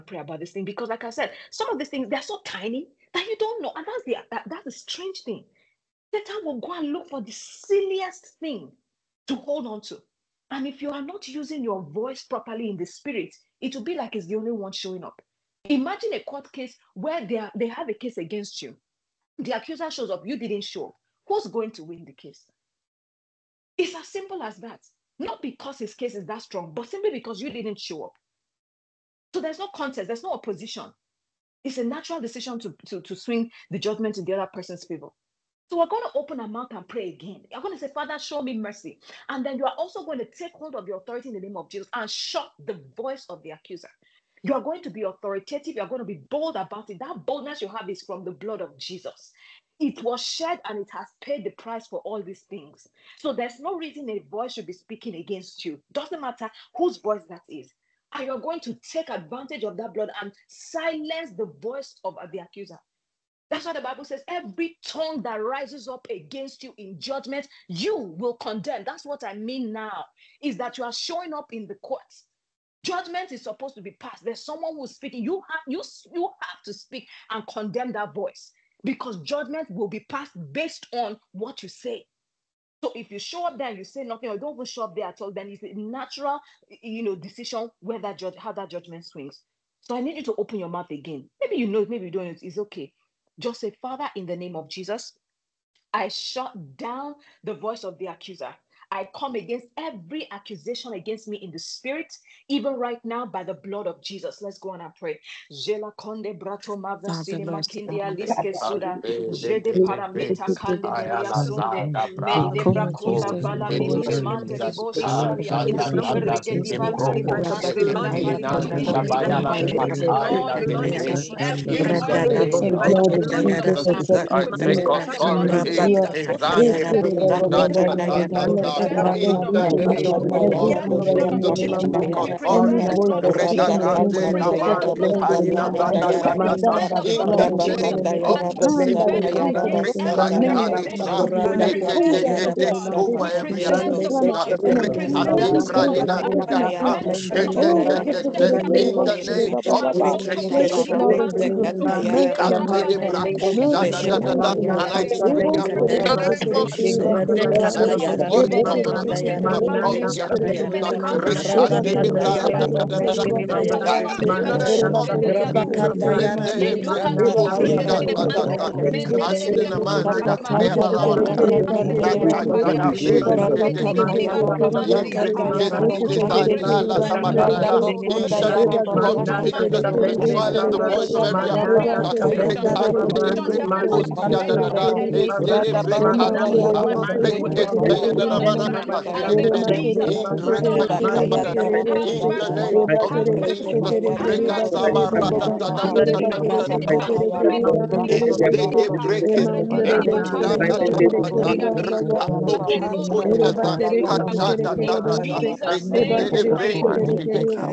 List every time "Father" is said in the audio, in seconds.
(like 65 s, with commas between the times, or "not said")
37 s, 93 s.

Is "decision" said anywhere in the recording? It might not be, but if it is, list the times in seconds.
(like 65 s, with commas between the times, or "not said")
32 s, 87 s.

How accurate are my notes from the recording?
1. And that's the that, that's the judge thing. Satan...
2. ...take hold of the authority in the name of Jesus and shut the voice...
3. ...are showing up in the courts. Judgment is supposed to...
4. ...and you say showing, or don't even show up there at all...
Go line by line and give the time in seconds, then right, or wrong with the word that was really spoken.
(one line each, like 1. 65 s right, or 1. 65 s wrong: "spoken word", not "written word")
1. 3 s wrong: "strange", not "judge"
2. 40 s right
3. 70 s right
4. 83 s wrong: "nothing", not "showing".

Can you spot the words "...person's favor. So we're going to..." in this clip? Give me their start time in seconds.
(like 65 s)
34 s.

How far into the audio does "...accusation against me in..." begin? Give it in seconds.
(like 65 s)
100 s.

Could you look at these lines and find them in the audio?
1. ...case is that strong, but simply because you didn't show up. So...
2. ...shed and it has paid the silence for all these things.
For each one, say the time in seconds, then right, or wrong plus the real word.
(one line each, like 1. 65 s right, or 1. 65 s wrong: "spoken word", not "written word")
1. 25 s right
2. 50 s wrong: "price", not "silence".